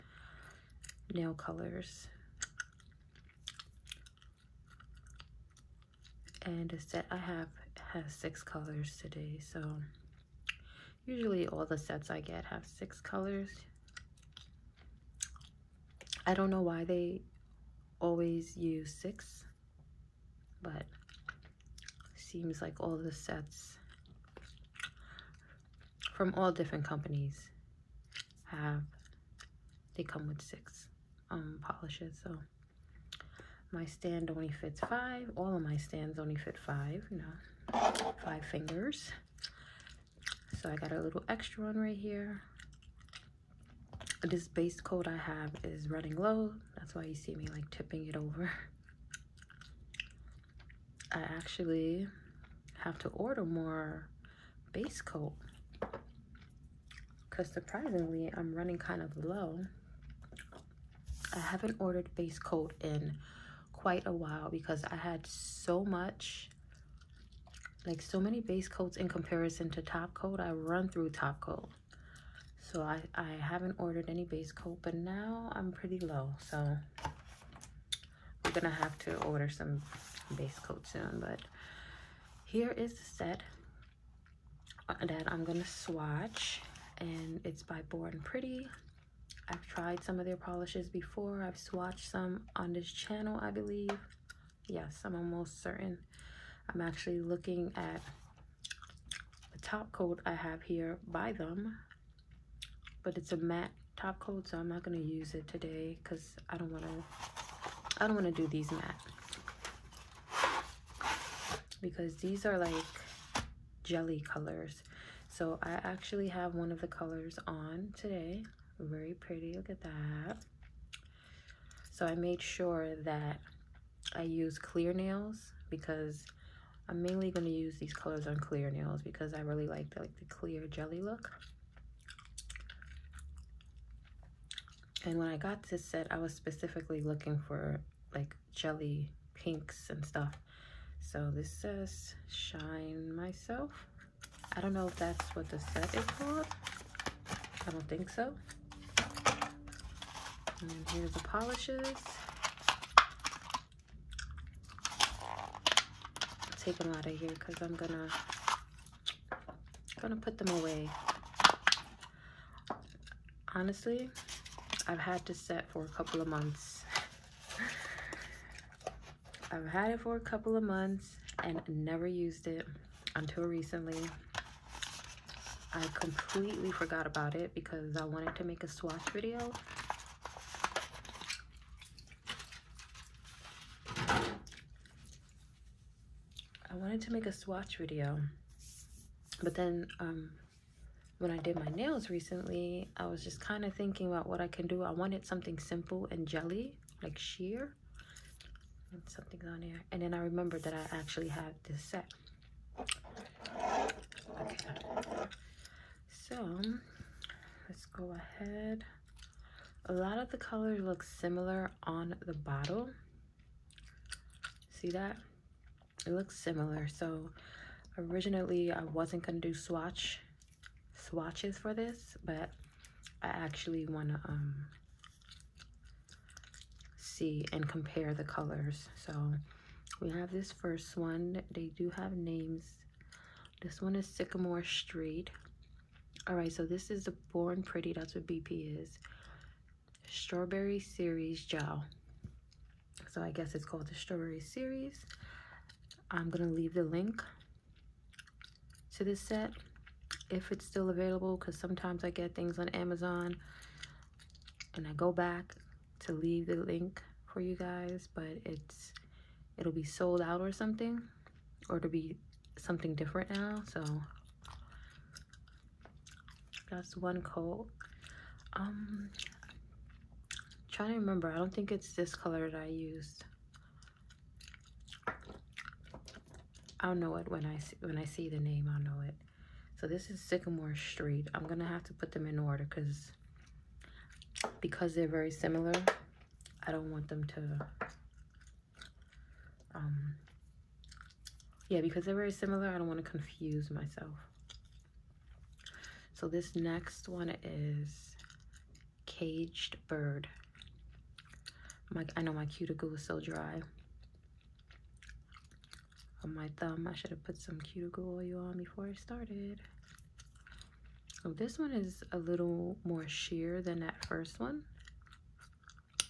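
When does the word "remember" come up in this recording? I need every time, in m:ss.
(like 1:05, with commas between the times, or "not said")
3:20, 4:30.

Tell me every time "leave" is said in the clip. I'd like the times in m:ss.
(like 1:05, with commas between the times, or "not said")
4:06, 4:16.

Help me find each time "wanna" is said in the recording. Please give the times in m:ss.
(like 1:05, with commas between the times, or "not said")
3:43.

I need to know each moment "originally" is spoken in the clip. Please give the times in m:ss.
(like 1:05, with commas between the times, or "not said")
3:37.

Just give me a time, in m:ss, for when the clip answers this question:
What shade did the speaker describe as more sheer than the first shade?
4:59.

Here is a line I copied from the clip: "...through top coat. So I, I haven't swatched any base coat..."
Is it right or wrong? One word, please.
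wrong.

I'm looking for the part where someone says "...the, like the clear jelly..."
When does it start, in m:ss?
2:09.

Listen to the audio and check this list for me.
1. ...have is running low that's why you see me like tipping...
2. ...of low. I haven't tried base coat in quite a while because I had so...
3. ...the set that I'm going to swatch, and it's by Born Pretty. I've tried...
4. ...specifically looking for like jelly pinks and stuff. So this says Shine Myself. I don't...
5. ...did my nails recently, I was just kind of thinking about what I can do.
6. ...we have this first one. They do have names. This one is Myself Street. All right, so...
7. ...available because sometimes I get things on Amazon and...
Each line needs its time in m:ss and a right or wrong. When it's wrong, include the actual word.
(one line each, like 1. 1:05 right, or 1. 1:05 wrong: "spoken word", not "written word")
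1. 0:45 right
2. 0:59 wrong: "ordered", not "tried"
3. 1:22 right
4. 2:16 right
5. 3:11 right
6. 3:50 wrong: "Sycamore", not "Myself"
7. 4:10 right.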